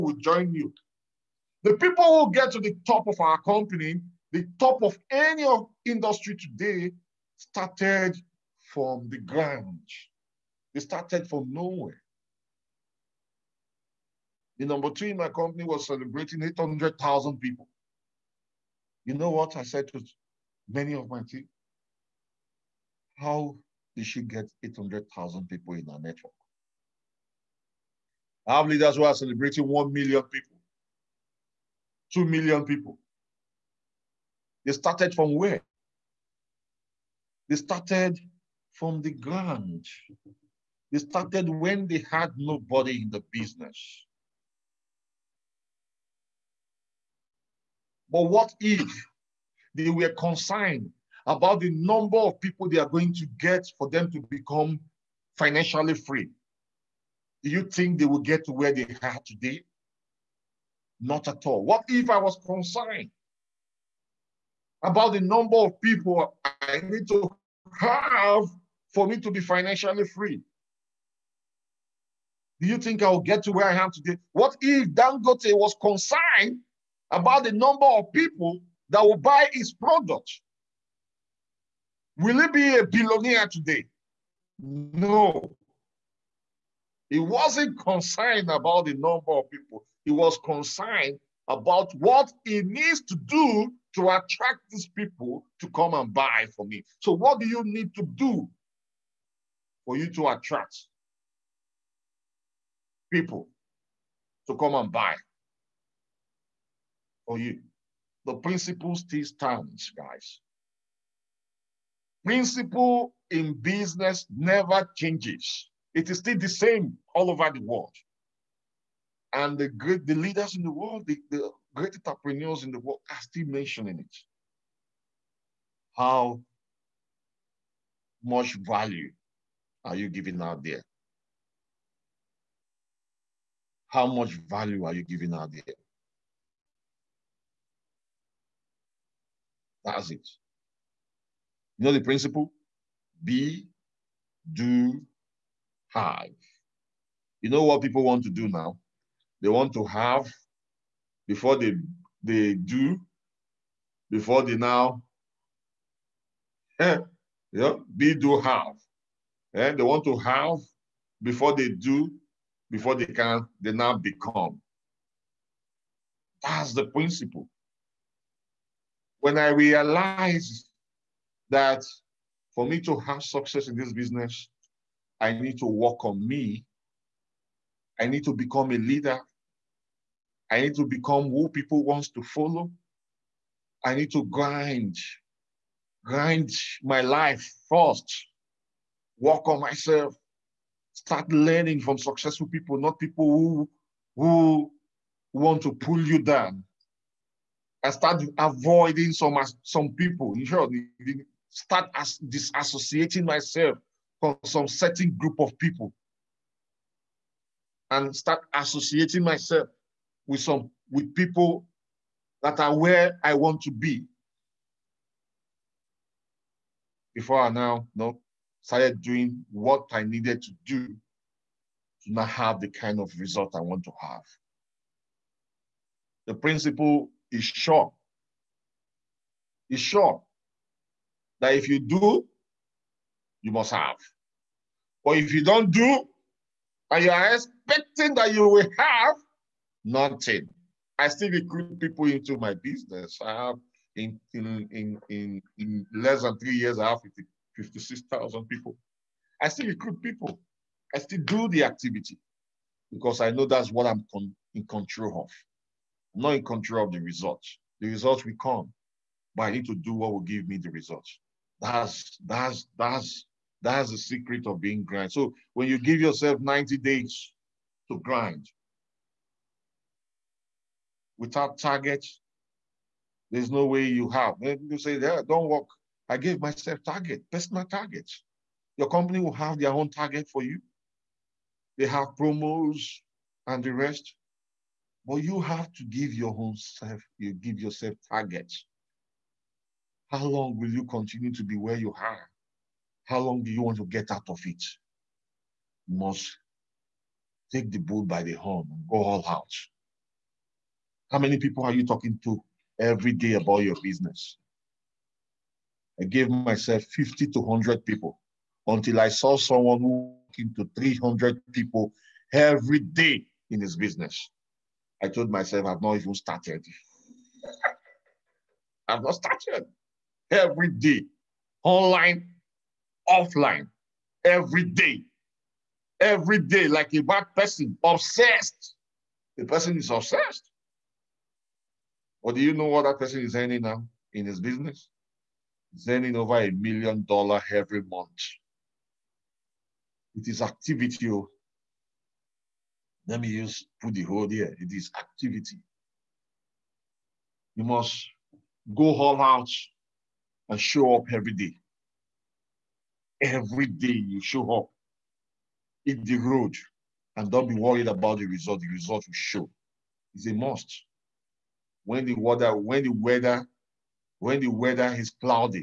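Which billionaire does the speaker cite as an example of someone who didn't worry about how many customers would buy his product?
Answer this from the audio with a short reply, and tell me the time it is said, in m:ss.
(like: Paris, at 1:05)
Dangote, at 1:14.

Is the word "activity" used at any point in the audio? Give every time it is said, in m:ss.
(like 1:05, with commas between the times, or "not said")
4:11, 5:40, 5:44.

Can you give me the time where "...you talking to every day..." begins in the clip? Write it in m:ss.
5:01.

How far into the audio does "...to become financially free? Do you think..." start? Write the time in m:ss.
0:54.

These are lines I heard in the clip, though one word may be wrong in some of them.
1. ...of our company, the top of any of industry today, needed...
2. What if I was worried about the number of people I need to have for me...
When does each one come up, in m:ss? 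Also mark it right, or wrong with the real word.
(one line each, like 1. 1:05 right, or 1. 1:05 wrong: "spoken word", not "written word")
1. 0:03 wrong: "started", not "needed"
2. 1:01 wrong: "concerned", not "worried".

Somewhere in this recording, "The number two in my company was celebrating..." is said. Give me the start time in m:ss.
0:14.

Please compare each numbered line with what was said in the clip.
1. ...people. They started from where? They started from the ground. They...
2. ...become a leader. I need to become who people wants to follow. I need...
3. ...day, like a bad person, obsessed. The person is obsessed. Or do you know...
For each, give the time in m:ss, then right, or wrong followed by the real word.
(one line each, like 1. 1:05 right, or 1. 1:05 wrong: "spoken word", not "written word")
1. 0:32 right
2. 2:58 right
3. 5:26 right.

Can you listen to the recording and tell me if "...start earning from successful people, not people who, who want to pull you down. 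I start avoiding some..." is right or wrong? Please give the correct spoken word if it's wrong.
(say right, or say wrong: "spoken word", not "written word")
wrong: "learning", not "earning".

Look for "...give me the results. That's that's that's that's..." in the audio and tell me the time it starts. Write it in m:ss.
4:20.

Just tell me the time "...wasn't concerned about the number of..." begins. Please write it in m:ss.
1:27.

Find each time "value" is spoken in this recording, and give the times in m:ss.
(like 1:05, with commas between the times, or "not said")
2:08, 2:14.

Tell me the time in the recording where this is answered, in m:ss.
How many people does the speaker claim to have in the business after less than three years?
4:07.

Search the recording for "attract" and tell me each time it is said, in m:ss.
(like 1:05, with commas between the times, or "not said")
1:34, 1:40.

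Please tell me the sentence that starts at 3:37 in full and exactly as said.
Before now, no, started doing what I needed to do to not have the kind of result I want to have.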